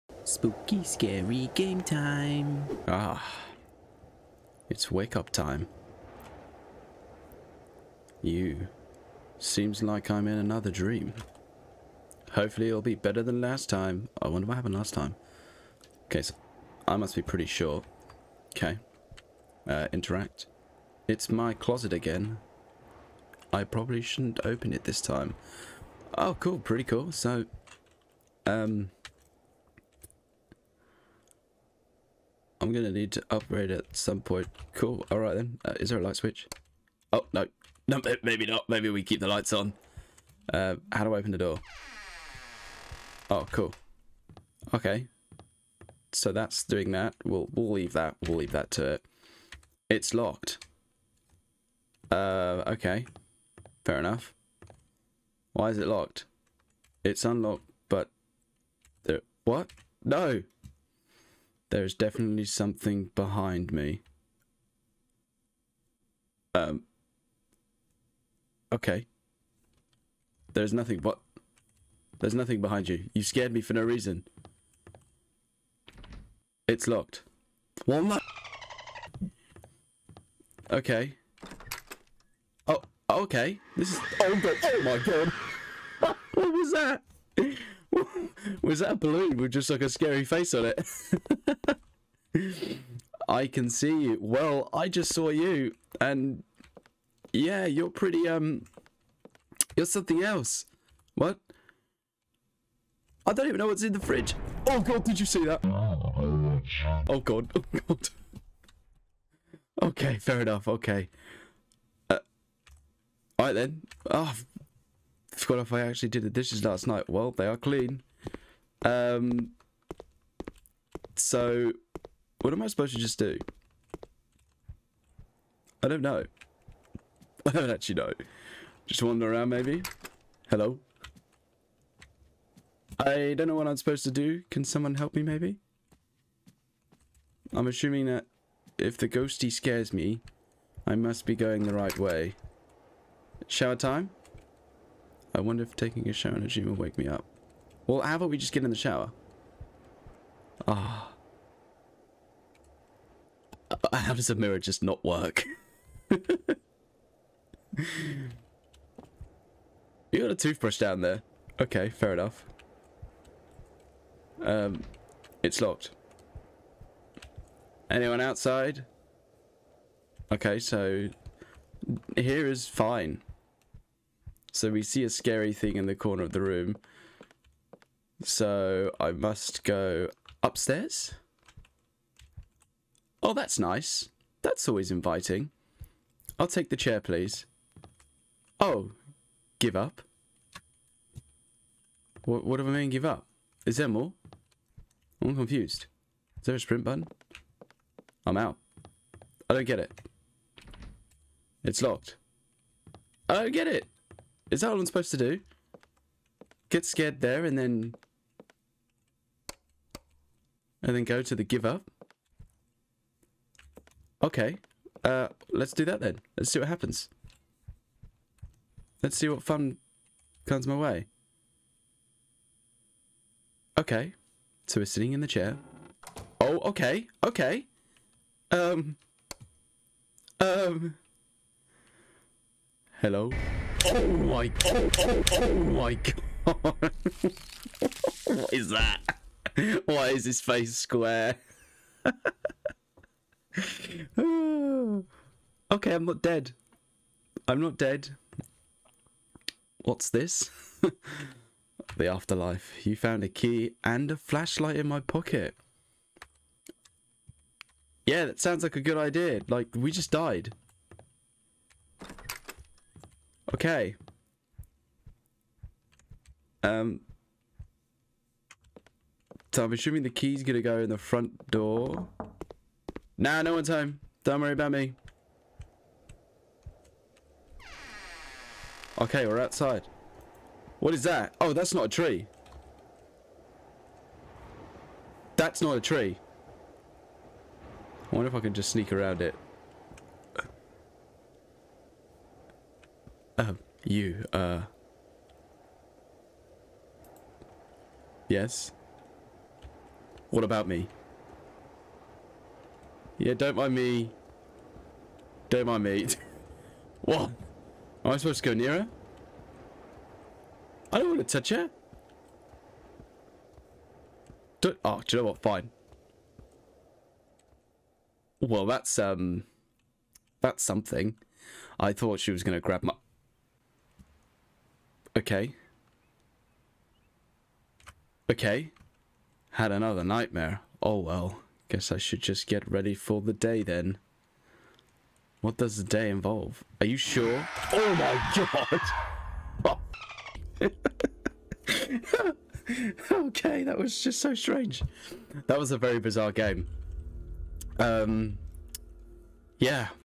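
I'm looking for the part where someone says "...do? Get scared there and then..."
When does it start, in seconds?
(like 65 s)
205 s.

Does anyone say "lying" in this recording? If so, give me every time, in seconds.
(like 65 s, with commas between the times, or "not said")
not said.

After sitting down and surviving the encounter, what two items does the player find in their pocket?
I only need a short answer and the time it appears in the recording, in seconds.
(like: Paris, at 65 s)
a key and a flashlight, at 253 s.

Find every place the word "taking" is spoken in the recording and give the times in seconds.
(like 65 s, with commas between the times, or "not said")
145 s.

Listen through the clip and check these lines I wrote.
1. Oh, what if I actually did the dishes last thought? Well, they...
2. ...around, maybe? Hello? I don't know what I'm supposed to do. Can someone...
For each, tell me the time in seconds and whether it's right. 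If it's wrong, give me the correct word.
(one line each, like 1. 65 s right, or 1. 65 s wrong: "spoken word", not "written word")
1. 114 s wrong: "night", not "thought"
2. 129 s right.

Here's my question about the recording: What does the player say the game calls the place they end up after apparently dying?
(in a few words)
the afterlife.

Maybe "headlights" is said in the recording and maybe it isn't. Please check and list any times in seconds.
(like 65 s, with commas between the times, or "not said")
not said.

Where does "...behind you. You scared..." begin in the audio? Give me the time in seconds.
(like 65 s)
72 s.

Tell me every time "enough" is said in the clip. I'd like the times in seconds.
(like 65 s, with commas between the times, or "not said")
53 s, 110 s, 162 s.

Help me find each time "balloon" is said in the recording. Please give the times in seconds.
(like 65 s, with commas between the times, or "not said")
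88 s.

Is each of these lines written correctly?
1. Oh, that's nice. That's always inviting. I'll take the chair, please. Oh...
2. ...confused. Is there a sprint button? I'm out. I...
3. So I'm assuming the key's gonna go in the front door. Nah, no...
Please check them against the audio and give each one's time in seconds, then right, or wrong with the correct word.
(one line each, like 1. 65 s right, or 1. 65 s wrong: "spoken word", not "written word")
1. 183 s right
2. 195 s right
3. 269 s right.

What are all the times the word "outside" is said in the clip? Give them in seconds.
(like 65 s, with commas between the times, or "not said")
168 s, 279 s.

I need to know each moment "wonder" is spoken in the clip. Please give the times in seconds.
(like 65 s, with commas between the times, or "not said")
14 s, 145 s, 288 s.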